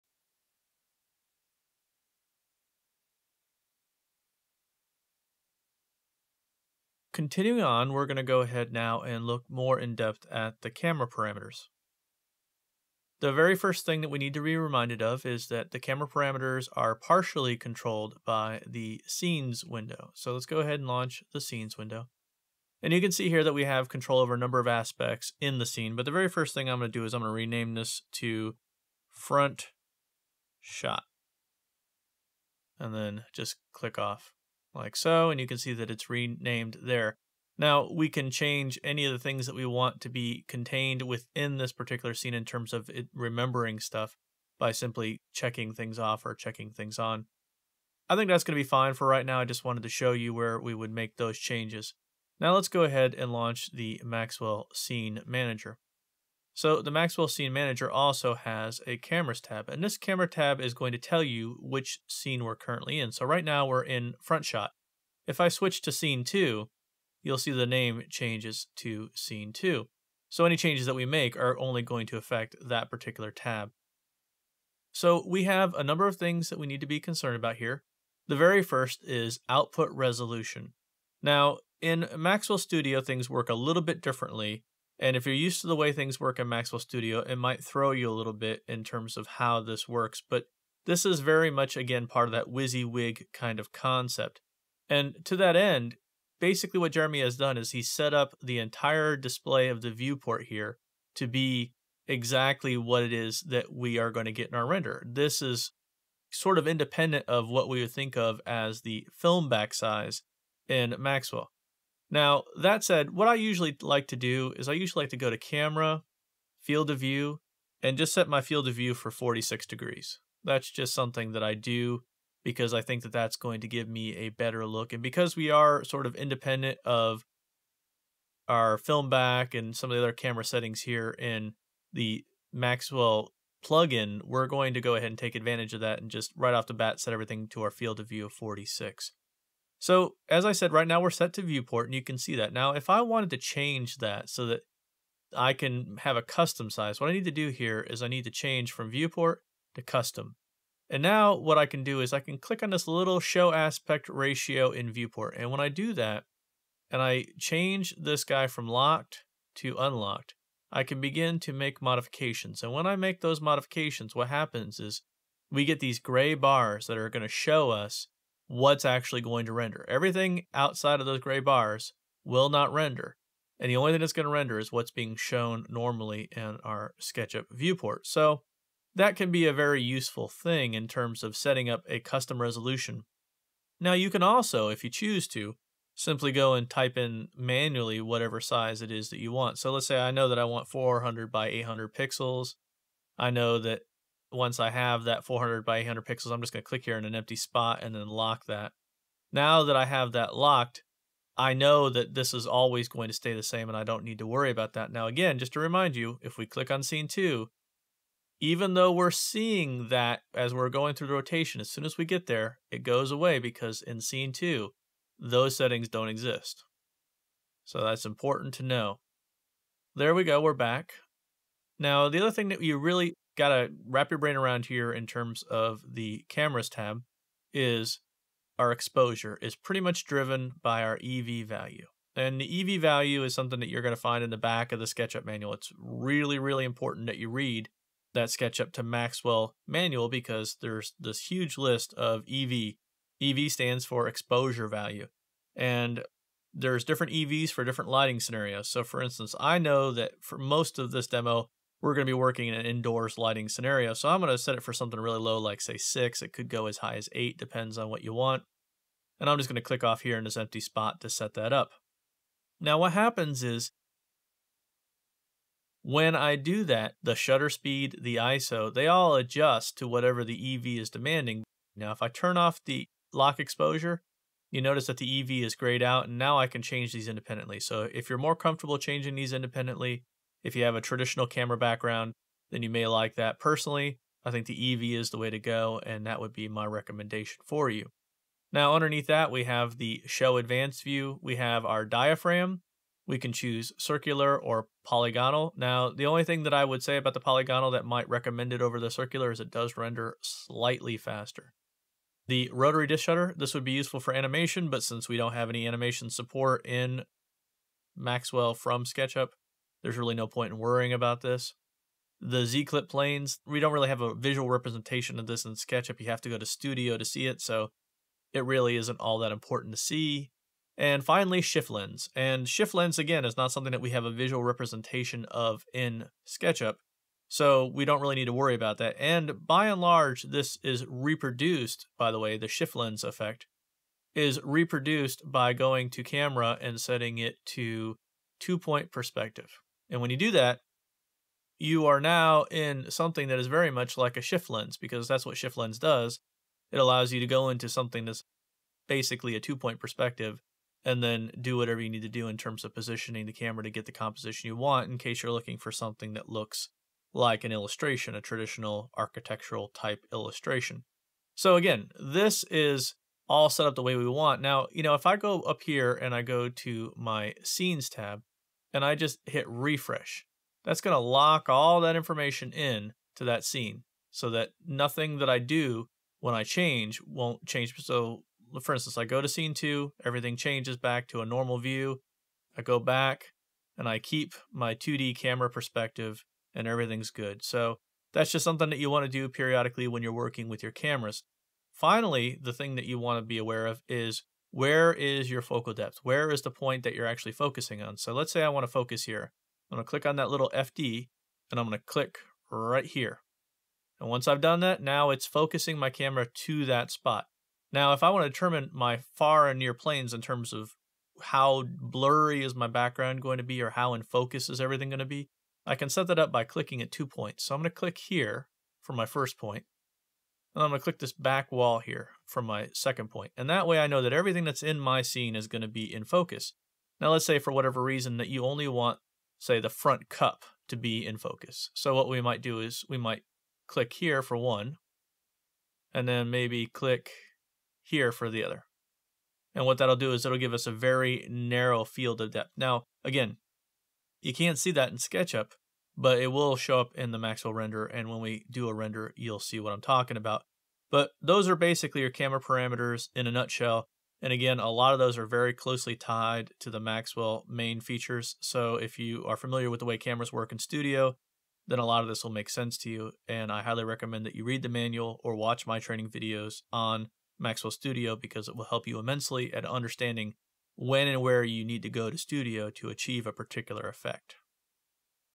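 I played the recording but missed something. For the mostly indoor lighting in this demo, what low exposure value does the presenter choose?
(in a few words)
6.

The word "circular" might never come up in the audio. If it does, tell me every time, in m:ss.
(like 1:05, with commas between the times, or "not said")
4:53, 4:58.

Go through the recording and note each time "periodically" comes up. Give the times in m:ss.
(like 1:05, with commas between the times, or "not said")
6:29.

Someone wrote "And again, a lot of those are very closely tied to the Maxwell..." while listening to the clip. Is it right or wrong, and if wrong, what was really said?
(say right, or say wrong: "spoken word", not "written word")
right.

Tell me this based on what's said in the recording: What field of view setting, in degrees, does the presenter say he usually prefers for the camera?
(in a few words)
46.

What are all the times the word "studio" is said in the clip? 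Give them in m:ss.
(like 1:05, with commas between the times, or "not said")
1:22, 1:26, 5:16, 7:40, 7:47, 7:52.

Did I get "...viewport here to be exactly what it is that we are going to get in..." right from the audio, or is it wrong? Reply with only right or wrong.
right.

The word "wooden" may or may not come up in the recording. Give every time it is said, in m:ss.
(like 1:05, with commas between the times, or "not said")
not said.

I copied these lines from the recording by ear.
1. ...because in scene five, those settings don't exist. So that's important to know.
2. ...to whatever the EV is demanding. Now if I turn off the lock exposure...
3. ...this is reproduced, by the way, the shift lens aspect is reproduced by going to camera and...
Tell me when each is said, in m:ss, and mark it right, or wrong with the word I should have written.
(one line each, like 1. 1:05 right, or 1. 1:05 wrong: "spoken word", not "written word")
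1. 3:33 wrong: "two", not "five"
2. 4:29 right
3. 5:30 wrong: "effect", not "aspect".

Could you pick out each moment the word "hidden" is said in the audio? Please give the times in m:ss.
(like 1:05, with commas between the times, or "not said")
not said.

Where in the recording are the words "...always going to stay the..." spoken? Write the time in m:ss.
3:22.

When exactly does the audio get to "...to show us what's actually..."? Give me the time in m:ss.
2:47.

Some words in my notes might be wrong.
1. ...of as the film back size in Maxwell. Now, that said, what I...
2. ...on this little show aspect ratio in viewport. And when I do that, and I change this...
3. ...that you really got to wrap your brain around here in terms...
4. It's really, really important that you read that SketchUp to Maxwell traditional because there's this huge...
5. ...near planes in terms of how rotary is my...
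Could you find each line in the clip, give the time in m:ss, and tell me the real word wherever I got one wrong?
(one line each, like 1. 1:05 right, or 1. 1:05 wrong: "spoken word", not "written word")
1. 1:48 right
2. 2:32 right
3. 3:42 right
4. 3:55 wrong: "manual", not "traditional"
5. 6:49 wrong: "blurry", not "rotary".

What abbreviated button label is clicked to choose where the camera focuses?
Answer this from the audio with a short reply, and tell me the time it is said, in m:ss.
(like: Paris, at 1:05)
FD, at 6:40.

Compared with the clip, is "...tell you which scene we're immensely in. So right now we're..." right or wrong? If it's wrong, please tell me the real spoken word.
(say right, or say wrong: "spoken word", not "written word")
wrong: "currently", not "immensely".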